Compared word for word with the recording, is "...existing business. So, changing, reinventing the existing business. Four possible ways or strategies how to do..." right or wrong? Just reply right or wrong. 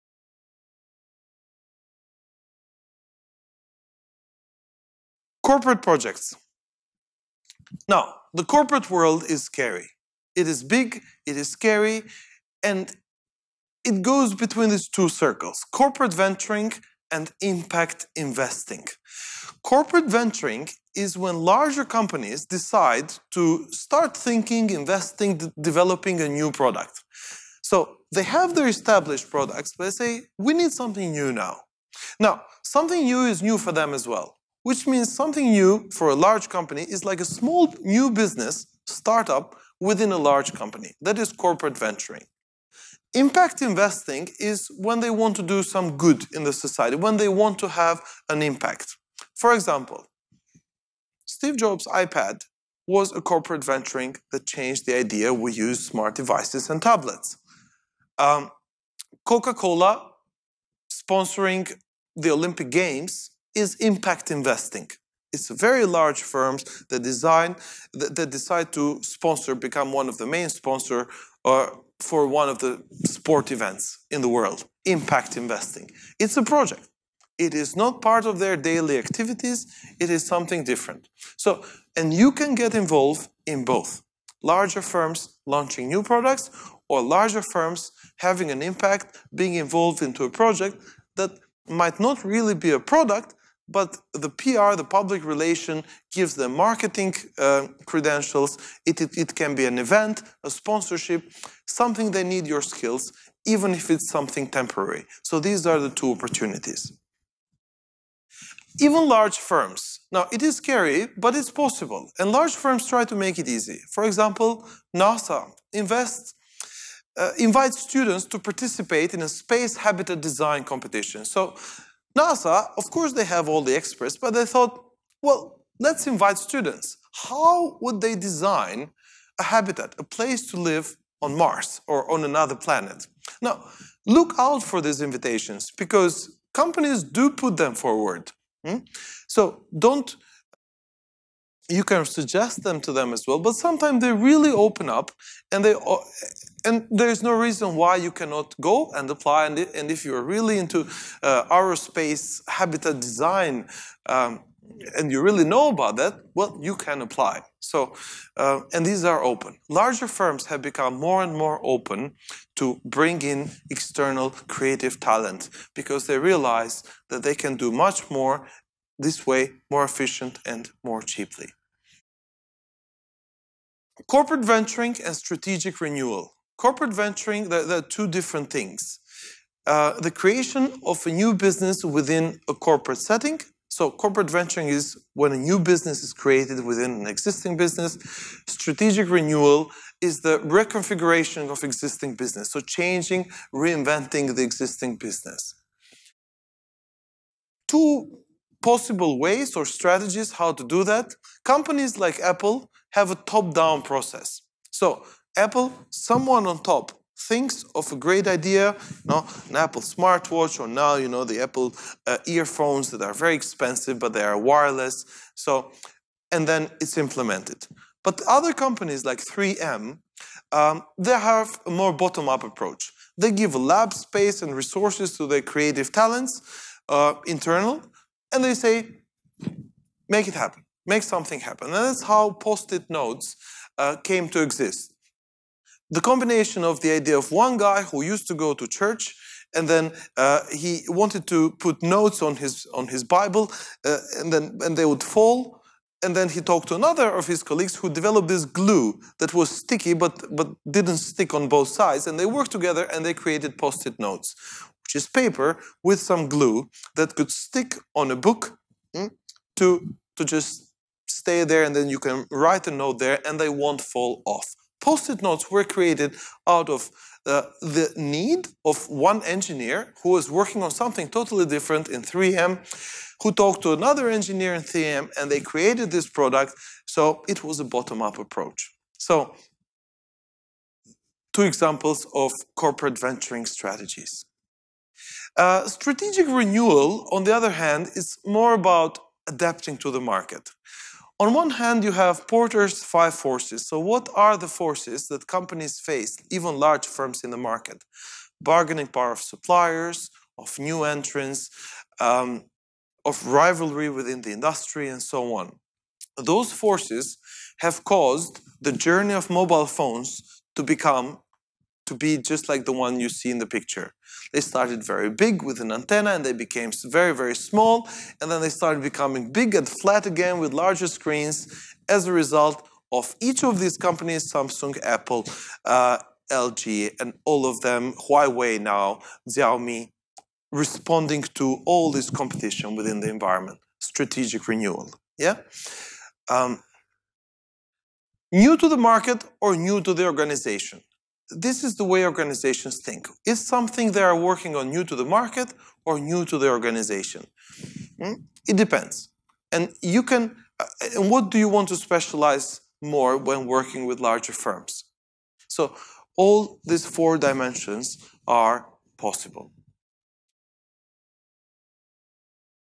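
wrong.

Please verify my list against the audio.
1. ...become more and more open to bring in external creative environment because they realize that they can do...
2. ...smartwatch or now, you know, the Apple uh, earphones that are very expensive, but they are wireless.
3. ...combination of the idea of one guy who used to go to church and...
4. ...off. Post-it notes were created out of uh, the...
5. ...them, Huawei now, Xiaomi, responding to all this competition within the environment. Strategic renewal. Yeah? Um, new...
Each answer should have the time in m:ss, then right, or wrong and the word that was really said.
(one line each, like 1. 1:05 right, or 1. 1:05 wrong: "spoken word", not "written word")
1. 2:40 wrong: "talent", not "environment"
2. 3:29 right
3. 3:56 right
4. 4:24 right
5. 5:27 right.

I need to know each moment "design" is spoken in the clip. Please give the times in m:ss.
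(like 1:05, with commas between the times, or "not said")
1:07, 2:00, 2:08, 2:32.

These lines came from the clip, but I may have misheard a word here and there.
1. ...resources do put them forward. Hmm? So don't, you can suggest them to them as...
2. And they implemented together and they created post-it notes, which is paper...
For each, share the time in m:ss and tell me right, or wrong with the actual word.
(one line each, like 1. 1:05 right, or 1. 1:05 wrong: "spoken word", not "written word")
1. 2:16 wrong: "companies", not "resources"
2. 4:12 wrong: "worked", not "implemented".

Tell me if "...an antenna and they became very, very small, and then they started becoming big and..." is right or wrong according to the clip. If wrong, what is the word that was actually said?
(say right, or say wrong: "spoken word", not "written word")
right.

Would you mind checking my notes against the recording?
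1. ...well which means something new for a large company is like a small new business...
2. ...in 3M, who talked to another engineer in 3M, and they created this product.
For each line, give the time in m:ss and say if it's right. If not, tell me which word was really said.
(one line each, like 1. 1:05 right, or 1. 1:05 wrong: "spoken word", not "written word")
1. 0:34 right
2. 4:31 right.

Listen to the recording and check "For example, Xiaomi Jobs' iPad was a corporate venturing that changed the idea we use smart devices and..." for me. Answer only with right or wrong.
wrong.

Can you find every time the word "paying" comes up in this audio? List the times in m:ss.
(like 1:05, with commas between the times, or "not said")
not said.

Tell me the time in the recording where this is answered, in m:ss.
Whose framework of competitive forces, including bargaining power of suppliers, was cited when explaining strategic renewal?
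4:52.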